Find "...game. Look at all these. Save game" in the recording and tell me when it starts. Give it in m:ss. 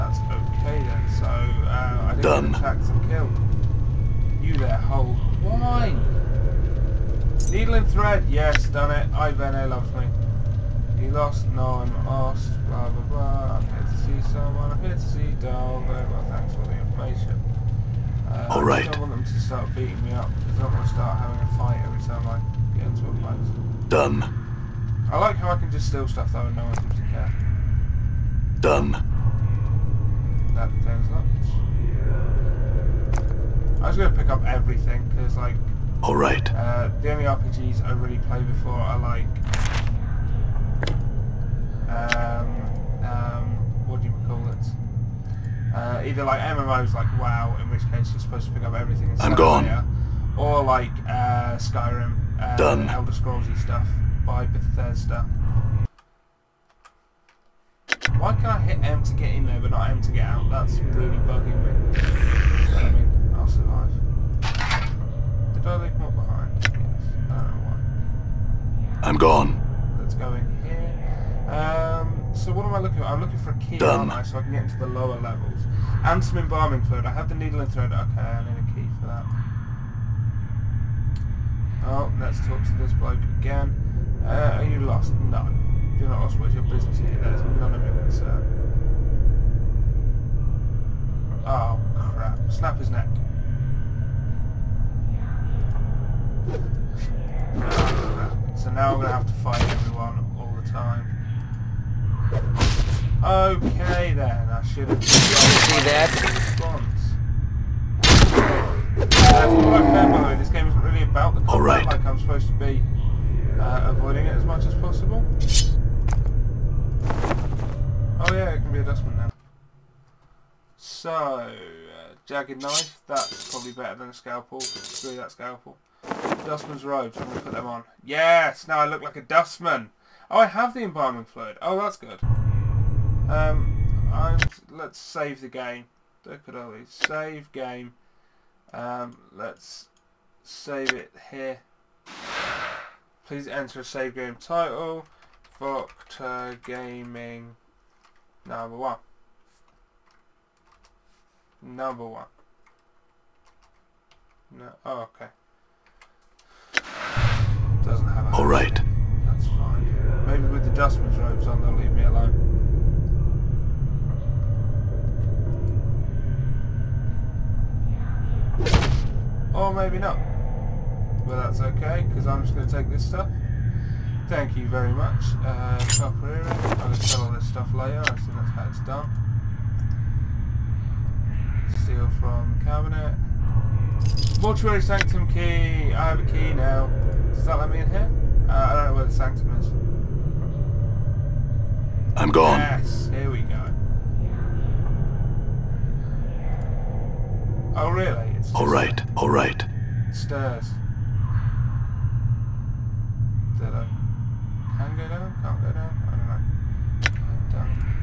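2:15.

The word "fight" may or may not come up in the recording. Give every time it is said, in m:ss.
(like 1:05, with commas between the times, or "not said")
0:21, 1:39.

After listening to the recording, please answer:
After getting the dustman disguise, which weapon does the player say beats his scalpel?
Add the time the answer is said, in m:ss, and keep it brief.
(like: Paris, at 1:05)
jagged knife, at 2:02.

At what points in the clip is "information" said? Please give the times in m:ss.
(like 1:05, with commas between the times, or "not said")
0:16.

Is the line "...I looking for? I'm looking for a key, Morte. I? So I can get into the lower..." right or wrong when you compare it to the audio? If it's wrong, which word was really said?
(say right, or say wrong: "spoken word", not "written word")
wrong: "Done", not "Morte".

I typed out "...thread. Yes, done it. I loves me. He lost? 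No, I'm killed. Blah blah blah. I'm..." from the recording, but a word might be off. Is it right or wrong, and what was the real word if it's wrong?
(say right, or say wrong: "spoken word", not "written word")
wrong: "asked", not "killed".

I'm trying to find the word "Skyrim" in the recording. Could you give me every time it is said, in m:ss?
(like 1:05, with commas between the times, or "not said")
0:51.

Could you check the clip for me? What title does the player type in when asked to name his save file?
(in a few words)
Proctor Gaming number one.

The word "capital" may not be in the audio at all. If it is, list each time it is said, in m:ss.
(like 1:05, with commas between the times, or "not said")
not said.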